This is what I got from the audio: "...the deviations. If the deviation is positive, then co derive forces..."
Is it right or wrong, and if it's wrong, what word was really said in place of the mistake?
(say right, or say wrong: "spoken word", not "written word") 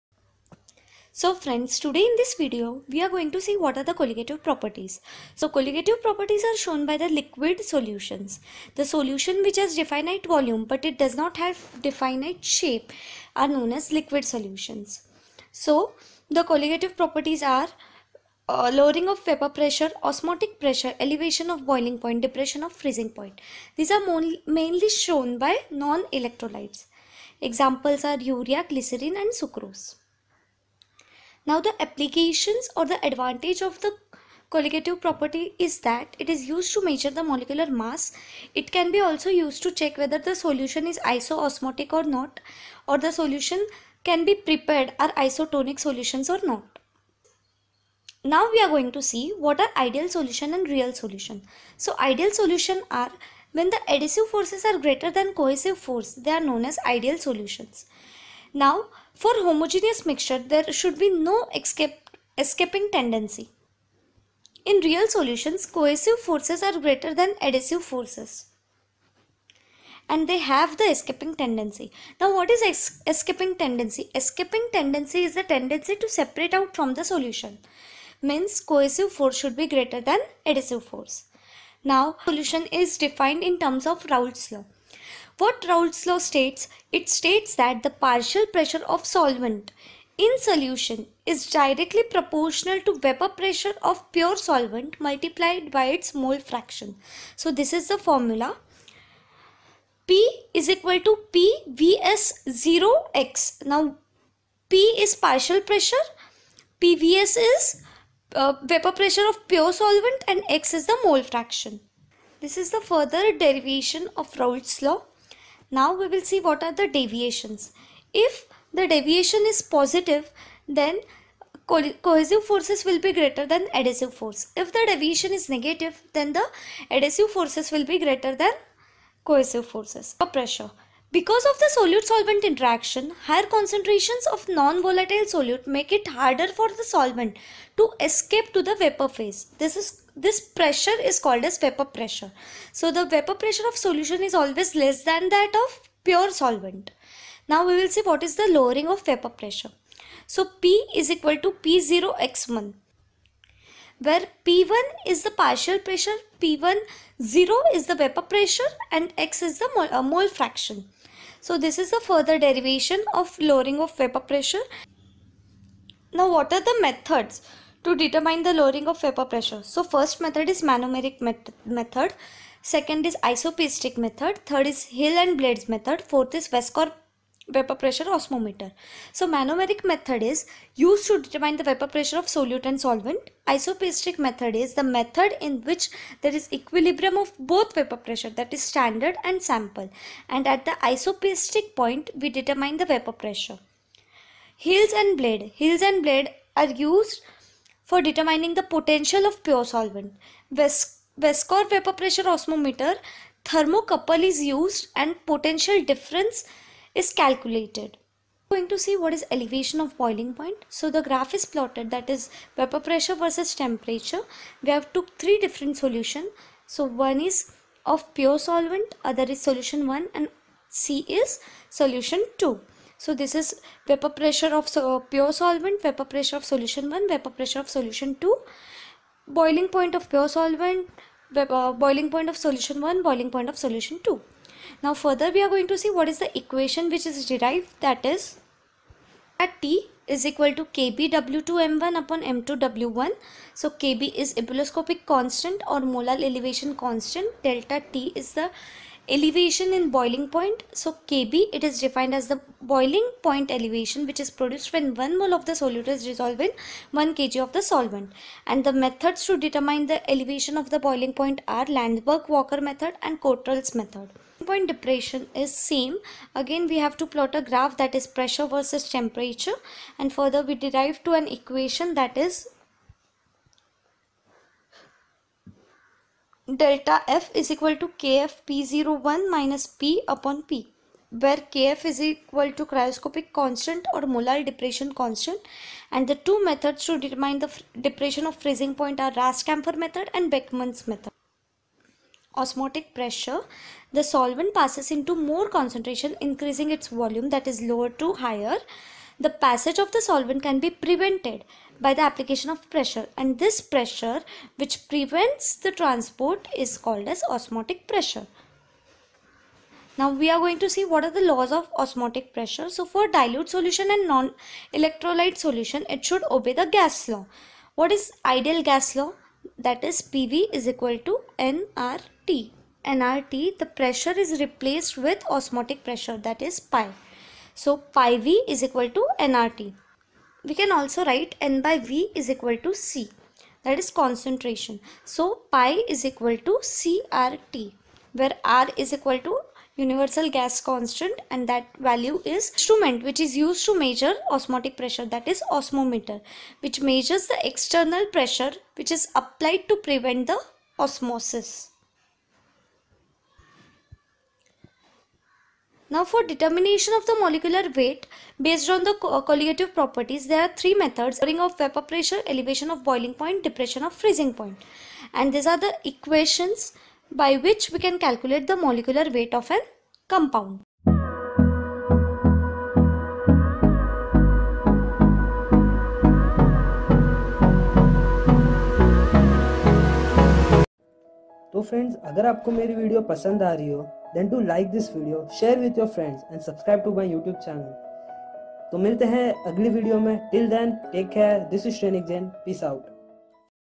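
wrong: "cohesive", not "derive".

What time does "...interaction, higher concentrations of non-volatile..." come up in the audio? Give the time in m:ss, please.
2:12.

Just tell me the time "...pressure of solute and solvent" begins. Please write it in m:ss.
3:01.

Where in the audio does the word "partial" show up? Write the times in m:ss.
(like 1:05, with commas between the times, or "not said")
1:27, 1:45, 2:35.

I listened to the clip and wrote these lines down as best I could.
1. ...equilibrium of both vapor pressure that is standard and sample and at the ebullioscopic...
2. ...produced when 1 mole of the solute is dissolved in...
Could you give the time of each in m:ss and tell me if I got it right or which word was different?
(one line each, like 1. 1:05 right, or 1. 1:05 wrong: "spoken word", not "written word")
1. 3:06 wrong: "isopiestic", not "ebullioscopic"
2. 4:14 right.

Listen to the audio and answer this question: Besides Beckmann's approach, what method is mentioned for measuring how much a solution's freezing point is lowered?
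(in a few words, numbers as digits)
Rast-Camphor method.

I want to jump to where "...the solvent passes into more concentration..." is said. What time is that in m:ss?
4:53.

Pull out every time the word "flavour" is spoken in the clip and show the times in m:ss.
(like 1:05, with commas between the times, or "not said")
not said.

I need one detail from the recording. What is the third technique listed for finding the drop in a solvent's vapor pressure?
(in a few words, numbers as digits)
Hill and Baldes method.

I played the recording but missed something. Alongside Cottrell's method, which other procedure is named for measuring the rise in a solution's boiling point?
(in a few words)
Landsberger Walker method.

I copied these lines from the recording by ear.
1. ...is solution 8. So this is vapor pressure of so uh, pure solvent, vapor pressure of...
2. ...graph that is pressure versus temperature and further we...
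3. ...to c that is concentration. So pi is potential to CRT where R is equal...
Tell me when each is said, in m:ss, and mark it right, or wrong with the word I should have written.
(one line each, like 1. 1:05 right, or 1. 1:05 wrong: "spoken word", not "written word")
1. 3:41 wrong: "2", not "8"
2. 4:27 right
3. 5:32 wrong: "equal", not "potential".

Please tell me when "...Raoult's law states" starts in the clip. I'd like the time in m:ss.
1:25.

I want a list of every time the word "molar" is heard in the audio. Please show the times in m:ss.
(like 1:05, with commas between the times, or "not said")
4:05, 4:44.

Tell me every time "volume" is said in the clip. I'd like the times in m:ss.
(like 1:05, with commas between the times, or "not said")
0:10, 4:56.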